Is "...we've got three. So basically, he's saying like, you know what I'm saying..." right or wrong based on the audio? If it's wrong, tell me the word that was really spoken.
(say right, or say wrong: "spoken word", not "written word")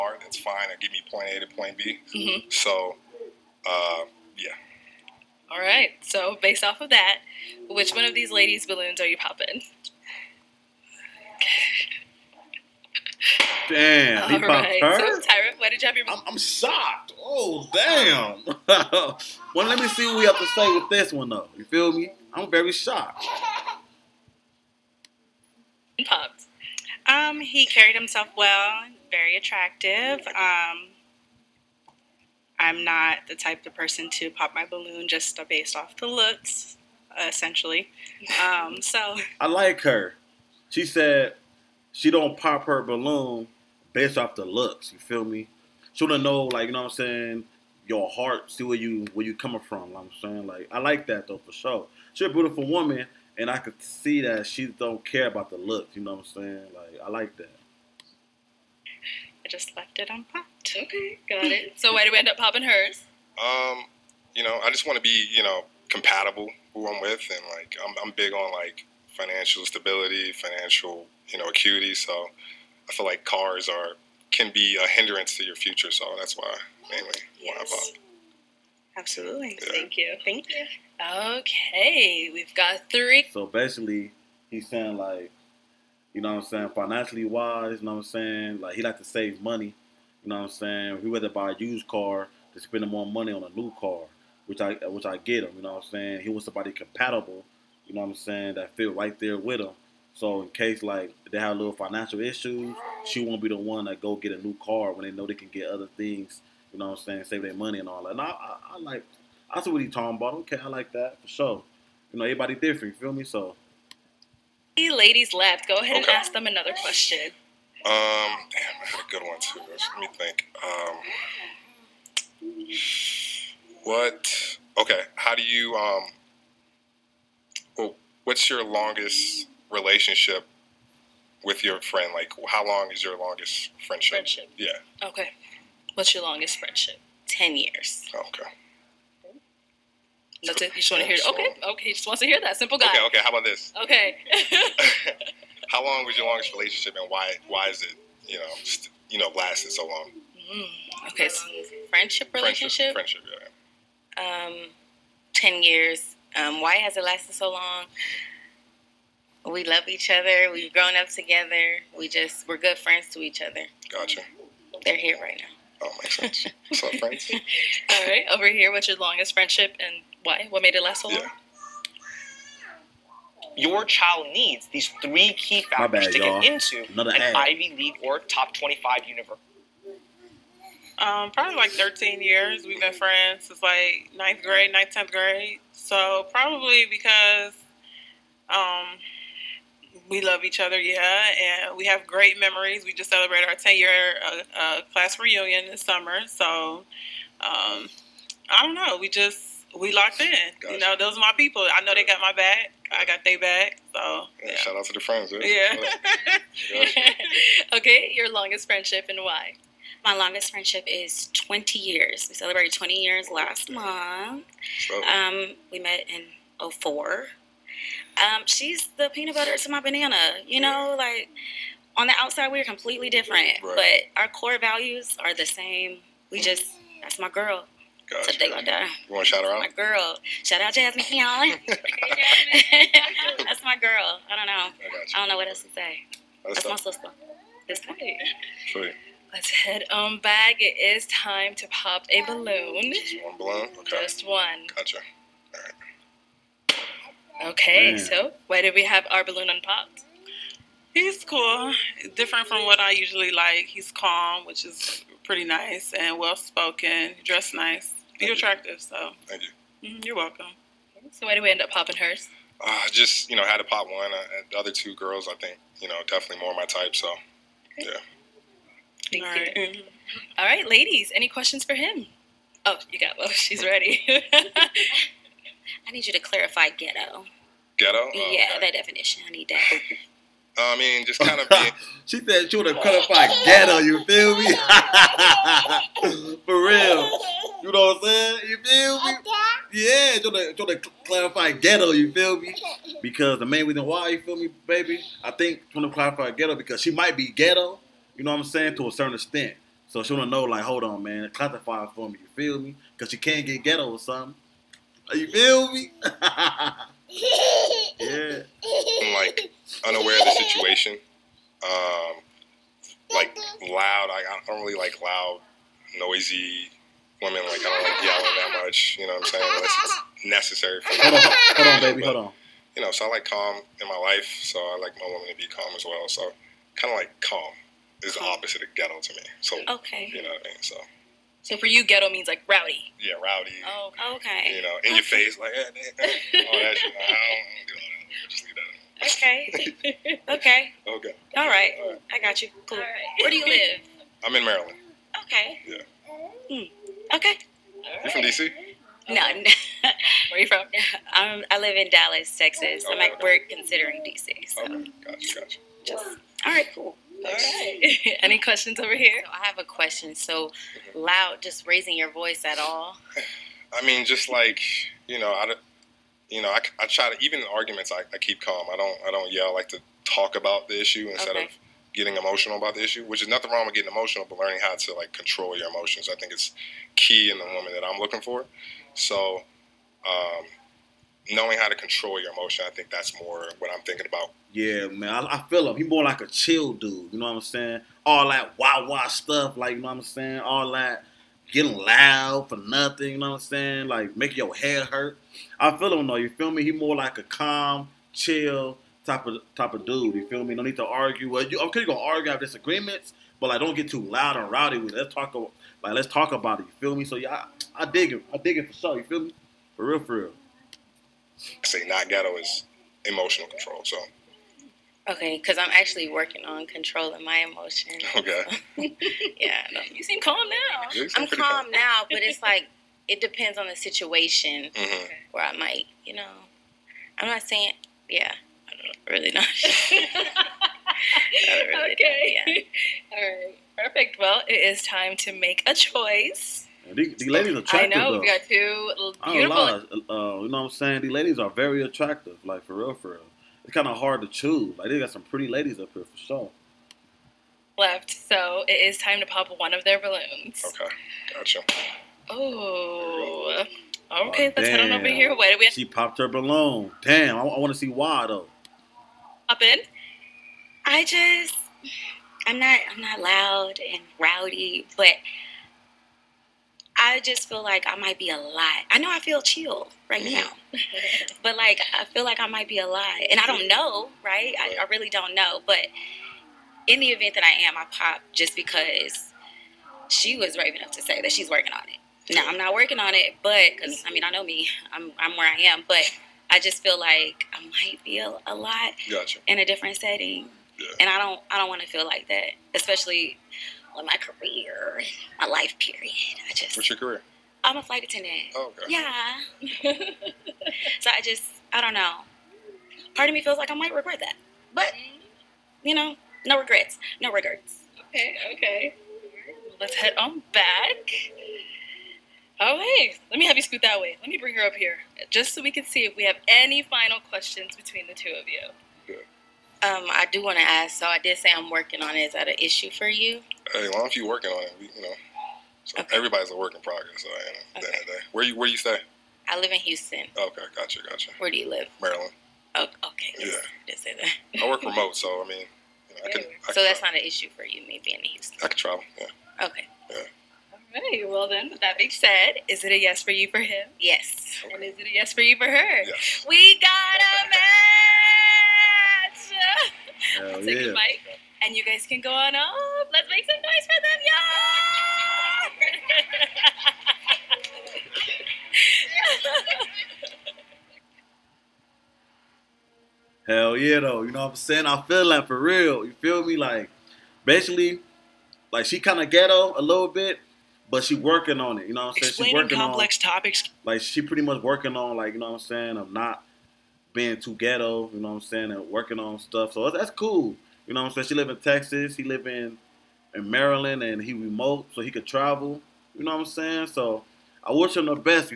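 right.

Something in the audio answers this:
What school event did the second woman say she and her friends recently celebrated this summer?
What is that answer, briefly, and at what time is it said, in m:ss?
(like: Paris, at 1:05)
10 year class reunion, at 3:13.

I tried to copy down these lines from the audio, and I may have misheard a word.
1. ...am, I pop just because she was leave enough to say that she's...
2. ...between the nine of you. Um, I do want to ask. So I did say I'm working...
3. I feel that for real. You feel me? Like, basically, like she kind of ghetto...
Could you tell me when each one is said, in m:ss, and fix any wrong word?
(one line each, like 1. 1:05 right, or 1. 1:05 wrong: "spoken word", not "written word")
1. 7:57 wrong: "brave", not "leave"
2. 8:37 wrong: "two", not "nine"
3. 9:24 right.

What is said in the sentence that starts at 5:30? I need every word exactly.
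So so for you, ghetto means like rowdy.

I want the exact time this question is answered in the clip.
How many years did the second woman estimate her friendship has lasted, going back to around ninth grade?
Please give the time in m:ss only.
3:01.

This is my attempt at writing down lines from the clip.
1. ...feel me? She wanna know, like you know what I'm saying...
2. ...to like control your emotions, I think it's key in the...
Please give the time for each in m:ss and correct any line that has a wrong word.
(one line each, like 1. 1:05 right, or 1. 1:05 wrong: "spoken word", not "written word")
1. 0:44 right
2. 6:14 right.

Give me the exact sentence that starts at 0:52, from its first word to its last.
She's a beautiful woman, and I could see that she don't care about the looks.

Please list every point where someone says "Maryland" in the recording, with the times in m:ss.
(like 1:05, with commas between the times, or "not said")
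5:44, 8:52, 9:43.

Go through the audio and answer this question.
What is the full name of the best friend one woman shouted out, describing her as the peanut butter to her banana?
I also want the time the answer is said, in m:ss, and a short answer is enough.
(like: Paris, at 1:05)
Jasmine Fion, at 3:50.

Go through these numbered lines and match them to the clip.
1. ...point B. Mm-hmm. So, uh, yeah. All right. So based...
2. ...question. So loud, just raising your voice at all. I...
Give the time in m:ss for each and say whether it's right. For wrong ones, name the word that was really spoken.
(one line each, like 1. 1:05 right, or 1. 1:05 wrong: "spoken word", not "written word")
1. 0:01 right
2. 5:59 right.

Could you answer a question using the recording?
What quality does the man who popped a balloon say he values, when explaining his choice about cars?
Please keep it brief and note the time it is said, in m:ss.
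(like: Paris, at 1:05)
financial stability, at 1:09.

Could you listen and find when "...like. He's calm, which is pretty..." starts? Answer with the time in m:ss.
4:13.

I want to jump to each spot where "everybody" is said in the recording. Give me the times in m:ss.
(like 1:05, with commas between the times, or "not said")
1:52, 8:46.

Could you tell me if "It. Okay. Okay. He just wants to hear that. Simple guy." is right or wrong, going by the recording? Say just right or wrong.
right.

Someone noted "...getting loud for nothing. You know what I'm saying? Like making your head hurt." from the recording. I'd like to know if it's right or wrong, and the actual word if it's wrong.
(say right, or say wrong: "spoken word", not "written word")
right.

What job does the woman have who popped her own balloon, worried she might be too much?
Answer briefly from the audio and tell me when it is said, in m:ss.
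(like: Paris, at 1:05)
flight attendant, at 8:17.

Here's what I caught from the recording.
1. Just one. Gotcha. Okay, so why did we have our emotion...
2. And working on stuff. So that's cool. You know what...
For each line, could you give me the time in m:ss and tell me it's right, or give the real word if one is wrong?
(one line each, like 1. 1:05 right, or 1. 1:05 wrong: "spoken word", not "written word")
1. 4:04 wrong: "balloon", not "emotion"
2. 9:38 right.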